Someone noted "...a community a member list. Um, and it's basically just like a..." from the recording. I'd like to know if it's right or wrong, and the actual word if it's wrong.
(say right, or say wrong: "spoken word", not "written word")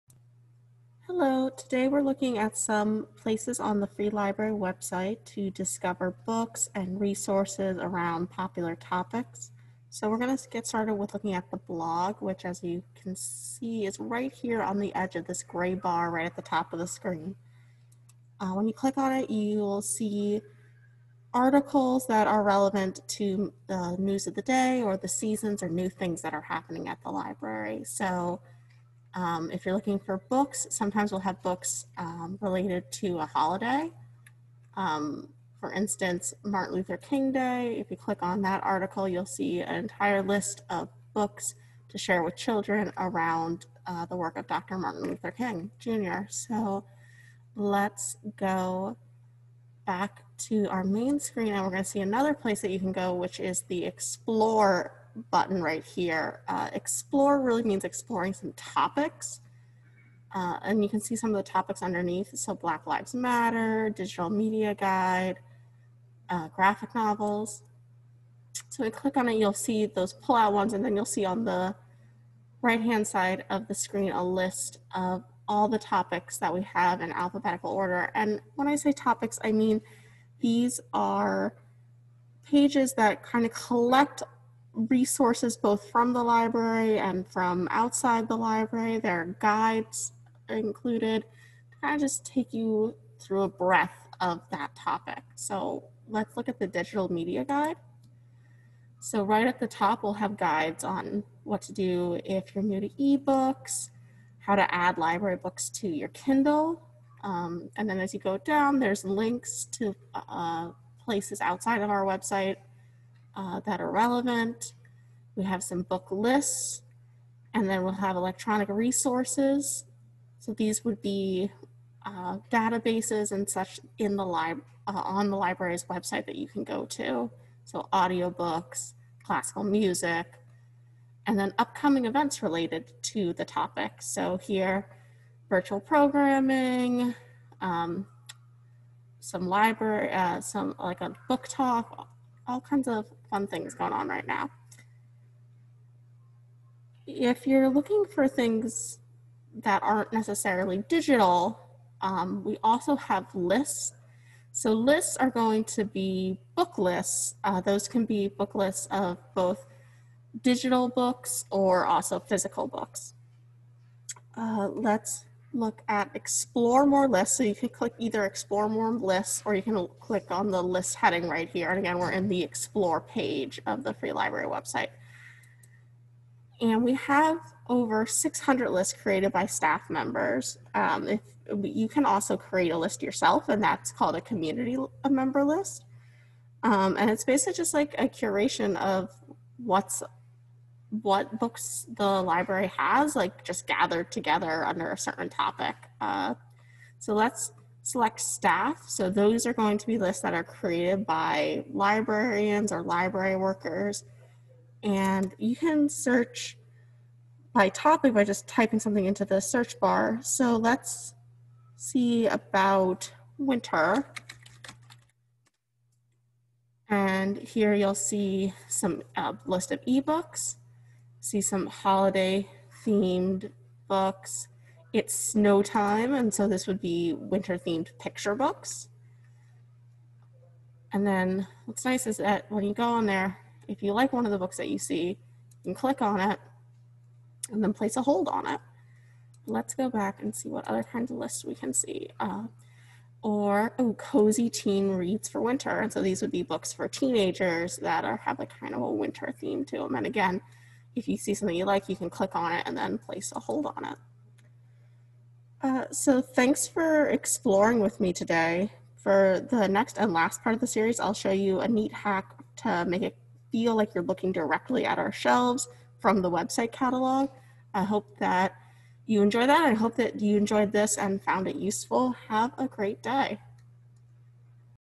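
right.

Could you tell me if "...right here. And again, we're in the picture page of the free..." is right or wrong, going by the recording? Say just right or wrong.
wrong.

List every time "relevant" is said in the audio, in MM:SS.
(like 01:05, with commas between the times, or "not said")
00:22, 01:53.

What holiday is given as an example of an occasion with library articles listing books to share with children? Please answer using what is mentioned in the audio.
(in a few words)
Martin Luther King Day.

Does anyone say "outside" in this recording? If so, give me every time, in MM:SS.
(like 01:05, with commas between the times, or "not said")
01:27, 01:51.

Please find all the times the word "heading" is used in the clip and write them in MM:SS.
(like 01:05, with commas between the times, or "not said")
02:50.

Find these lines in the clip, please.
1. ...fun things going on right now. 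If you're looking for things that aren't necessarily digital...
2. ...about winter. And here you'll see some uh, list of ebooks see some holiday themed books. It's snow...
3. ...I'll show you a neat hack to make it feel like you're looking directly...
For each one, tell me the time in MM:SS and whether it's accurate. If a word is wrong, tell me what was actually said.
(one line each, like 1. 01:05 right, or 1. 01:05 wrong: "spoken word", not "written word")
1. 02:23 right
2. 03:32 right
3. 04:20 right.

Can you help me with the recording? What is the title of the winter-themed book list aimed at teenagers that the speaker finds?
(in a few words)
Cozy Teen Reads for Winter.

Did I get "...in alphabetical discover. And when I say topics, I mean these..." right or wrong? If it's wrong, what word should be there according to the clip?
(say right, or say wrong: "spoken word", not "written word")
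wrong: "order", not "discover".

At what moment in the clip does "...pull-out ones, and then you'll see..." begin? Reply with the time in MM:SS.
01:10.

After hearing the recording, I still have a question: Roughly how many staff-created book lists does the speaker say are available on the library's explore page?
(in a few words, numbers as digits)
over 600.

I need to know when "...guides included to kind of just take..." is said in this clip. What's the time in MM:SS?
01:29.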